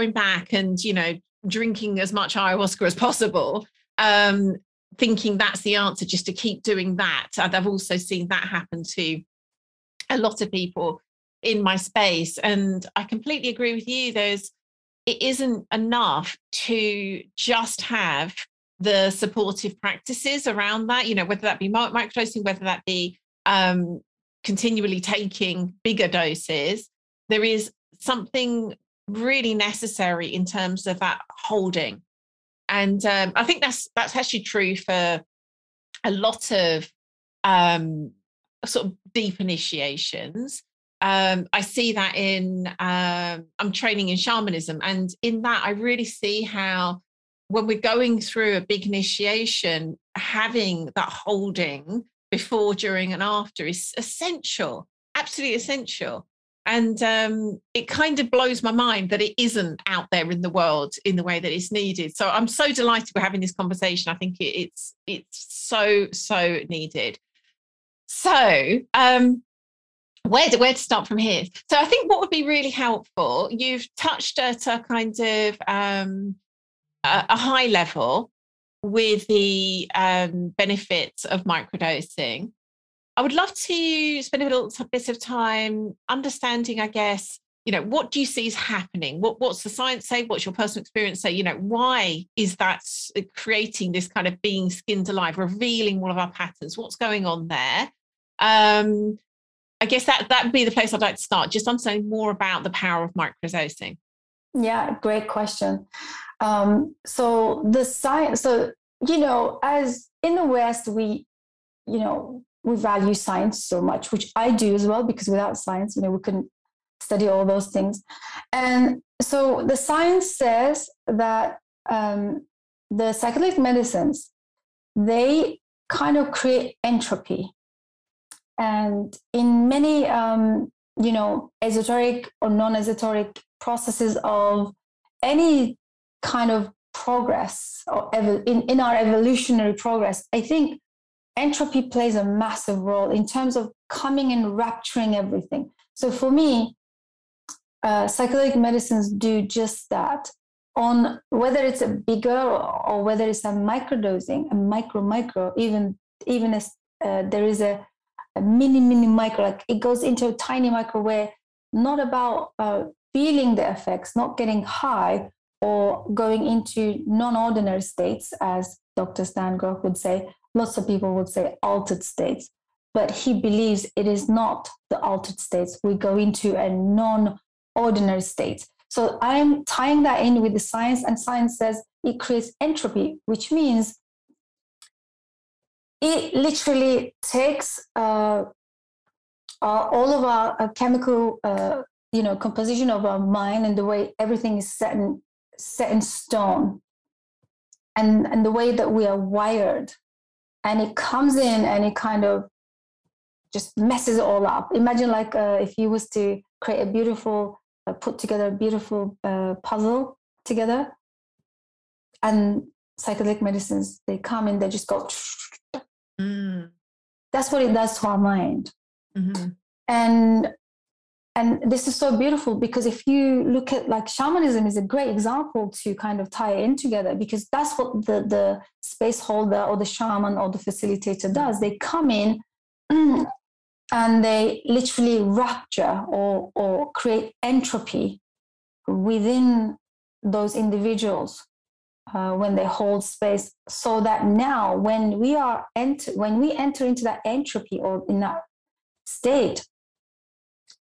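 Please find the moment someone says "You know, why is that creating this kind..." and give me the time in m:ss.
1:31.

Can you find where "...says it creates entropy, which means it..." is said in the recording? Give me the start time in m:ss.
3:01.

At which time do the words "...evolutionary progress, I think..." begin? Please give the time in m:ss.
2:18.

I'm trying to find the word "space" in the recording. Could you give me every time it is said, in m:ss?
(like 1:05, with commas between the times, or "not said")
0:11, 3:48, 4:03.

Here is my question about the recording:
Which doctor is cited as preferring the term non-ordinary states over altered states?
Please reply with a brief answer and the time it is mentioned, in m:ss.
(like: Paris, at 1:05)
Dr. Stan Grof, at 2:48.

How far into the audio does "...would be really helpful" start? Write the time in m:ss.
1:12.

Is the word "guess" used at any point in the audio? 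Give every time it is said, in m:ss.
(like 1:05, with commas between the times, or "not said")
1:26, 1:39.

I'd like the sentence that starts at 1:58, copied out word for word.
And so the science says that um, the psychedelic medicines, they kind of create entropy.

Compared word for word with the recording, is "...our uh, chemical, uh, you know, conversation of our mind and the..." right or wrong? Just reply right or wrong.
wrong.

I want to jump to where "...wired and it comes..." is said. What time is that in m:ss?
3:19.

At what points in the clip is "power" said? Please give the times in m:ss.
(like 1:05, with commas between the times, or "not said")
1:42.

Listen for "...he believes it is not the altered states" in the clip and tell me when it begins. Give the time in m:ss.
2:53.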